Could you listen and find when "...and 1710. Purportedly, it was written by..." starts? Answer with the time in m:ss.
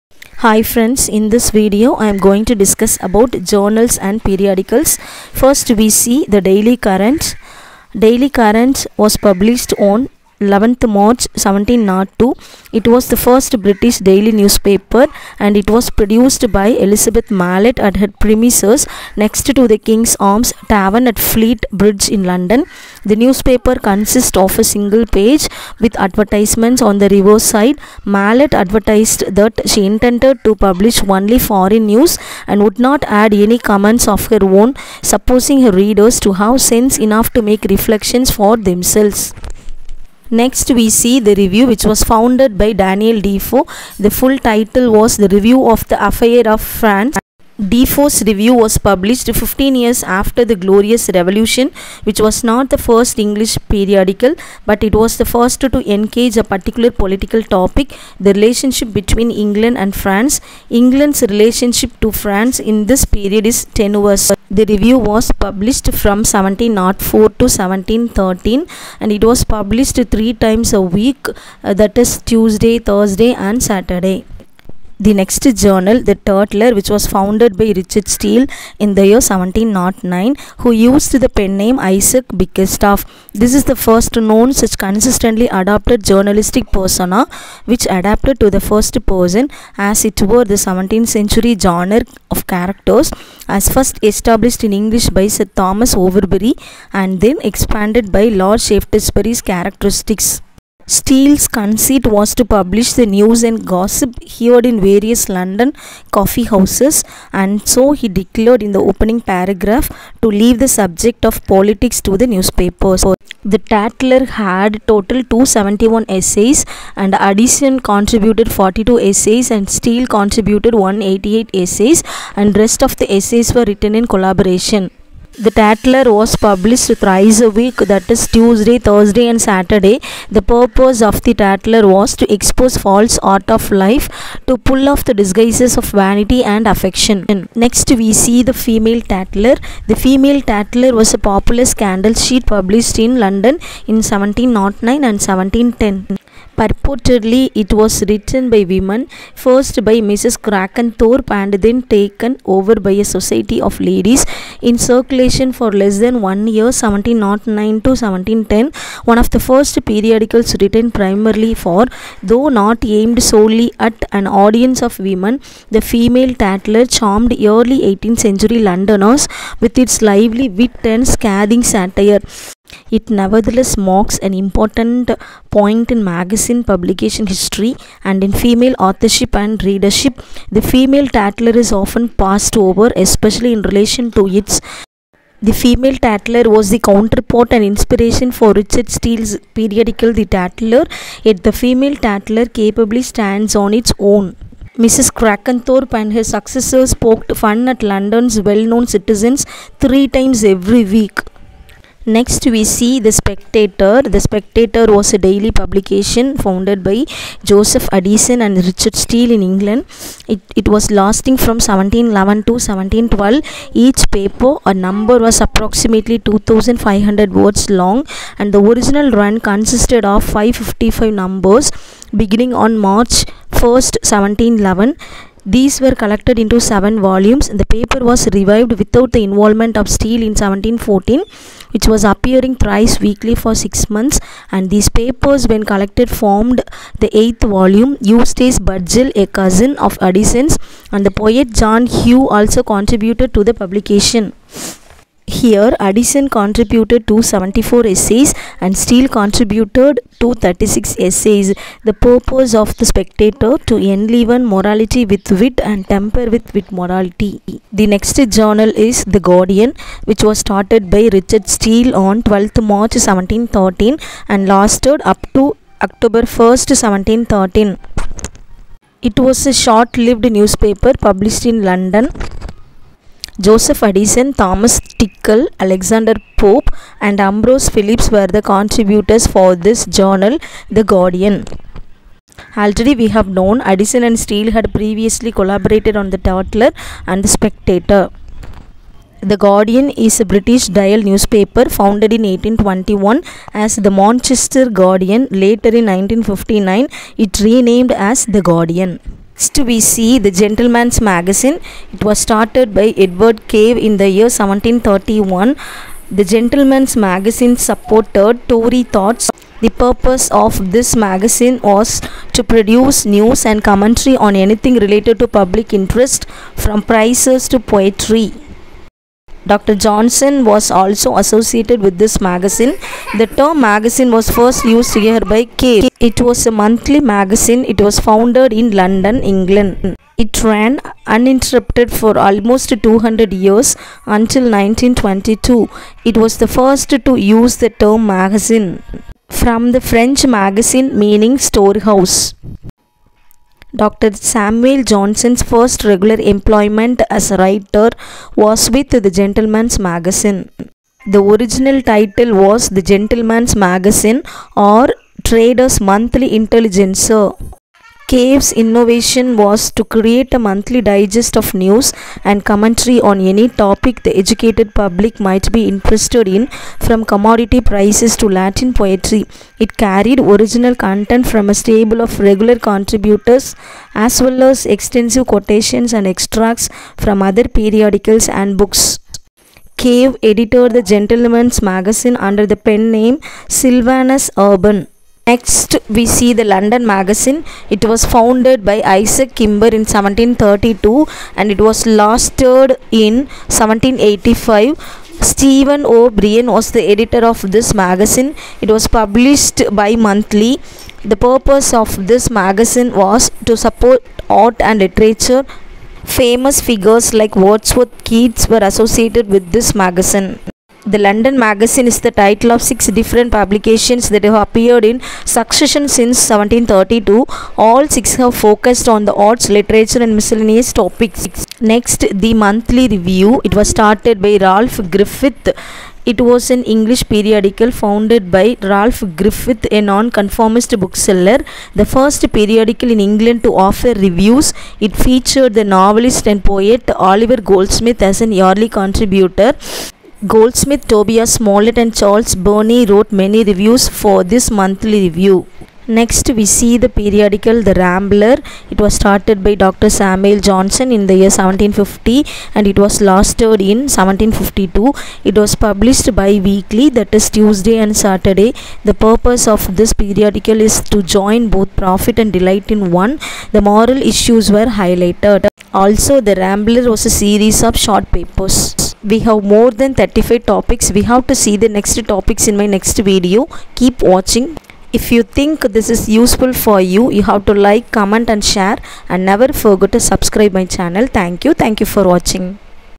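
2:25.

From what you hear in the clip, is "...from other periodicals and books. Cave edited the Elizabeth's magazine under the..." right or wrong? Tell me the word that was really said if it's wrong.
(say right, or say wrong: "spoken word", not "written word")
wrong: "Gentleman", not "Elizabeth".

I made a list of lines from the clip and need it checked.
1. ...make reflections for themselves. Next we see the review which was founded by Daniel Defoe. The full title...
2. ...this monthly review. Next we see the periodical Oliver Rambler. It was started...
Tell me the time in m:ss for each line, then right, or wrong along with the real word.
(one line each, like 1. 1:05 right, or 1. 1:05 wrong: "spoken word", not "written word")
1. 0:37 right
2. 7:24 wrong: "The", not "Oliver".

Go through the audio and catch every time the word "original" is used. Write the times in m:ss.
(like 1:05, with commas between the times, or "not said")
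3:38, 5:51, 6:10.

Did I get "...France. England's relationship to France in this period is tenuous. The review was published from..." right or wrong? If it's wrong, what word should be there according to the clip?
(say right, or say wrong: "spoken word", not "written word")
right.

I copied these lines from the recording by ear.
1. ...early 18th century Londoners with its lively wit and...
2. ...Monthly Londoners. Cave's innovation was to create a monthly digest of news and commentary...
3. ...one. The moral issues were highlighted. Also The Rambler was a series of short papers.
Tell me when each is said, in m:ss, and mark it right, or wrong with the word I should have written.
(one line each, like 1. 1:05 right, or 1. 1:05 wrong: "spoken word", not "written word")
1. 2:47 right
2. 5:55 wrong: "Intelligencer", not "Londoners"
3. 7:42 right.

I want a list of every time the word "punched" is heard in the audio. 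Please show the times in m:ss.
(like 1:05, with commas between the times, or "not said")
not said.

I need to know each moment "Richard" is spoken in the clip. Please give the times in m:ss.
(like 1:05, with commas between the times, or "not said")
1:17, 3:08, 3:28, 4:21.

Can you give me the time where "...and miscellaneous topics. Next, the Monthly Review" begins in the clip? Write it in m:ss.
7:00.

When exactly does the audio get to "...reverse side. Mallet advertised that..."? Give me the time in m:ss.
0:27.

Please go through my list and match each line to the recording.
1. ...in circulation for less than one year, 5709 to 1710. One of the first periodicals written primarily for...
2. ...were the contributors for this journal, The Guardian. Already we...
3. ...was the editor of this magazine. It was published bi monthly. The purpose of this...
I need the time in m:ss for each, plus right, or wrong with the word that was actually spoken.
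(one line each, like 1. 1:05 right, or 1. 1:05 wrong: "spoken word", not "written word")
1. 2:34 wrong: "1709", not "5709"
2. 4:38 right
3. 6:36 right.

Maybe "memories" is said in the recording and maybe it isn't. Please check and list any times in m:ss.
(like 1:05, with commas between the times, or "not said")
not said.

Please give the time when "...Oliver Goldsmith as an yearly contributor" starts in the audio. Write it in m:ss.
7:16.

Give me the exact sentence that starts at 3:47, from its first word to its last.
The paper was revived without the involvement of Steele in 1714, which was appearing thrice weekly for six months.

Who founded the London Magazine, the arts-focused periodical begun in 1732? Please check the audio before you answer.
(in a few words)
Isaac Kimber.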